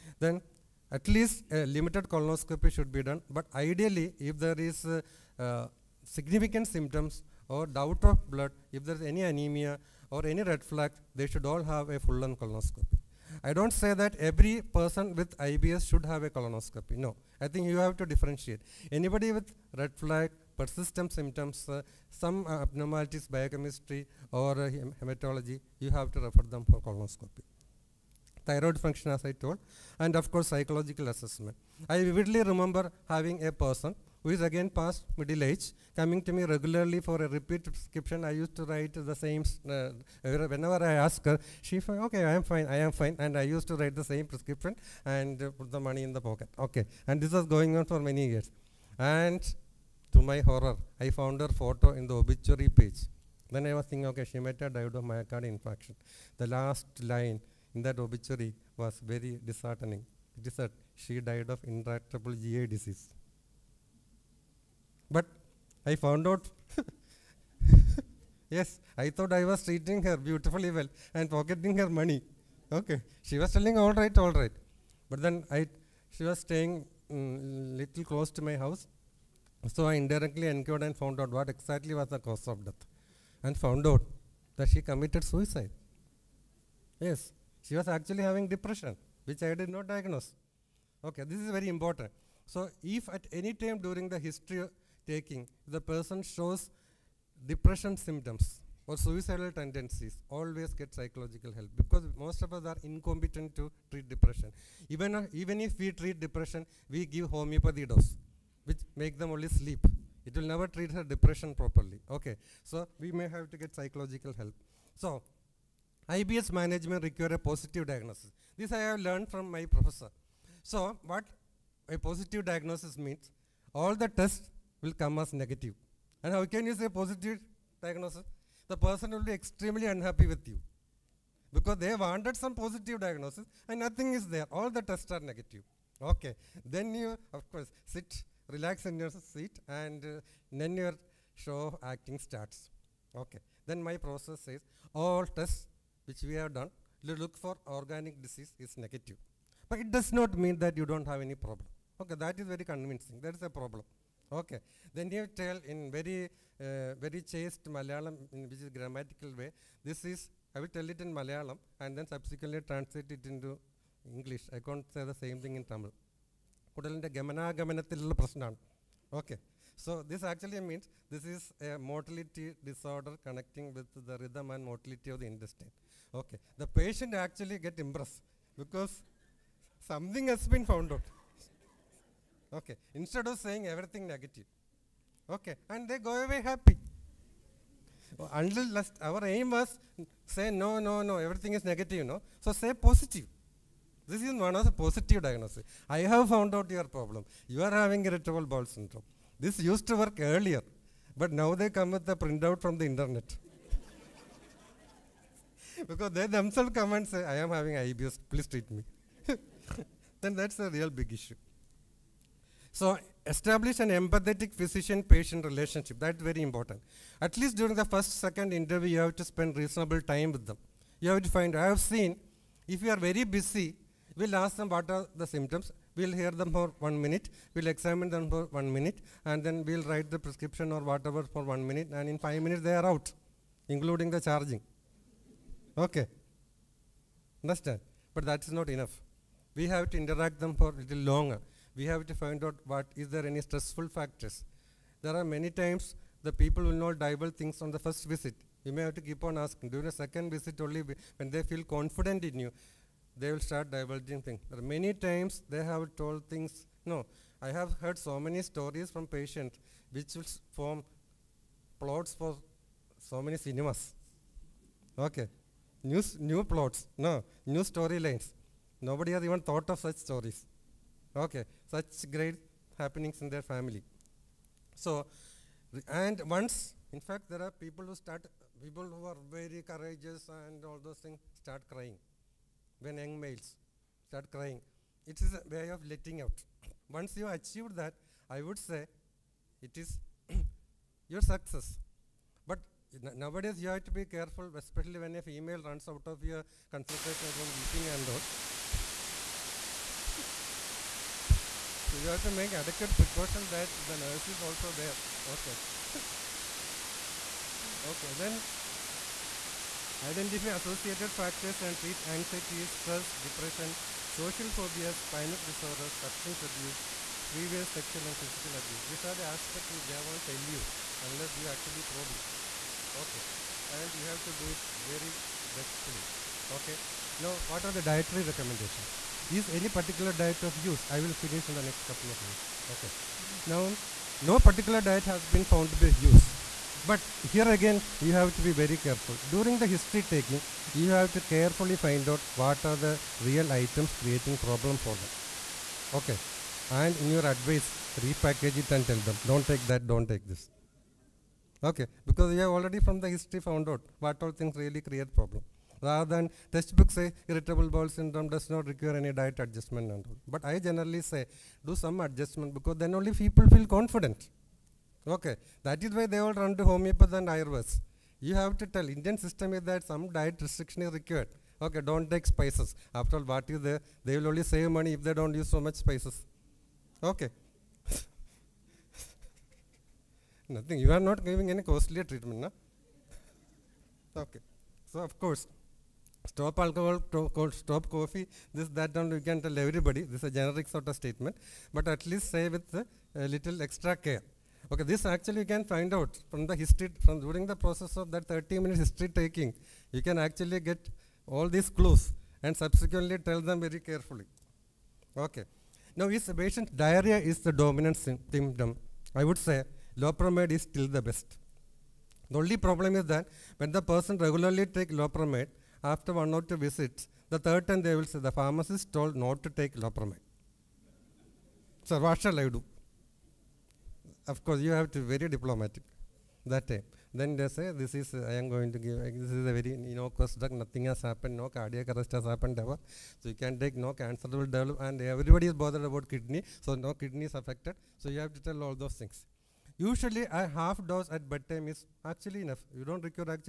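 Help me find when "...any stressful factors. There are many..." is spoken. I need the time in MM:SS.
04:03.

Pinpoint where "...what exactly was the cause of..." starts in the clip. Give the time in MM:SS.
01:21.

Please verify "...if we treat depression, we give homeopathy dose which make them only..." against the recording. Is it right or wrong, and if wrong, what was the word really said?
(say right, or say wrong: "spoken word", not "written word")
right.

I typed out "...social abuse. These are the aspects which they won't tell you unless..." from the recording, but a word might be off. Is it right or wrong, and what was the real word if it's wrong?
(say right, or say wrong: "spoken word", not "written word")
wrong: "physical", not "social".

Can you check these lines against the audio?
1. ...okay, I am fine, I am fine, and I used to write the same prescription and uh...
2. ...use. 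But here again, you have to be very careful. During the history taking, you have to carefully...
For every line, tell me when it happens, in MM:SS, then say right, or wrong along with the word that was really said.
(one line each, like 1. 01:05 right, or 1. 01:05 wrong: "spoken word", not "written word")
1. 00:42 right
2. 05:35 right.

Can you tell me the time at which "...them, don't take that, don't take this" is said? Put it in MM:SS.
05:49.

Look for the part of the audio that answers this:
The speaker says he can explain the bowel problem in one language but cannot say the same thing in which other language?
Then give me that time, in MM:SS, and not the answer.
02:45.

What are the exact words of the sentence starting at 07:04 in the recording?
of course you have to be very diplomatic that time.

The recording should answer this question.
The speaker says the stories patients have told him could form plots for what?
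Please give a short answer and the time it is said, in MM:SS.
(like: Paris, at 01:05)
cinemas, at 04:23.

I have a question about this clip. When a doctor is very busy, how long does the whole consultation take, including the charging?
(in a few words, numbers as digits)
5 minutes.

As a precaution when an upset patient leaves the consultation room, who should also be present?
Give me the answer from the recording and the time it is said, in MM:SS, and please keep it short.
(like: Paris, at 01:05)
the nurse, at 05:03.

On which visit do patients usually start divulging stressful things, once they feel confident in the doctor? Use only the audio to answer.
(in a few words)
second visit.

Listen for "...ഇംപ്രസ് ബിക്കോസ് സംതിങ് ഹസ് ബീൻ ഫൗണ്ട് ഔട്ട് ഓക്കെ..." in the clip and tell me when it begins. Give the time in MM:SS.
02:57.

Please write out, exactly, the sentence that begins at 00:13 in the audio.
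I don't say that every person with IBS should have a colonoscopy.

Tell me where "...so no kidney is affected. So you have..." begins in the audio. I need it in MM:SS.
07:16.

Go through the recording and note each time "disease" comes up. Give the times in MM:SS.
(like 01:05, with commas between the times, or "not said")
01:02, 02:28.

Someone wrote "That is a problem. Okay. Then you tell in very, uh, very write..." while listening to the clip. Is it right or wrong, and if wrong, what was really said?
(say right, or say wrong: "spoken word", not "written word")
wrong: "chaste", not "write".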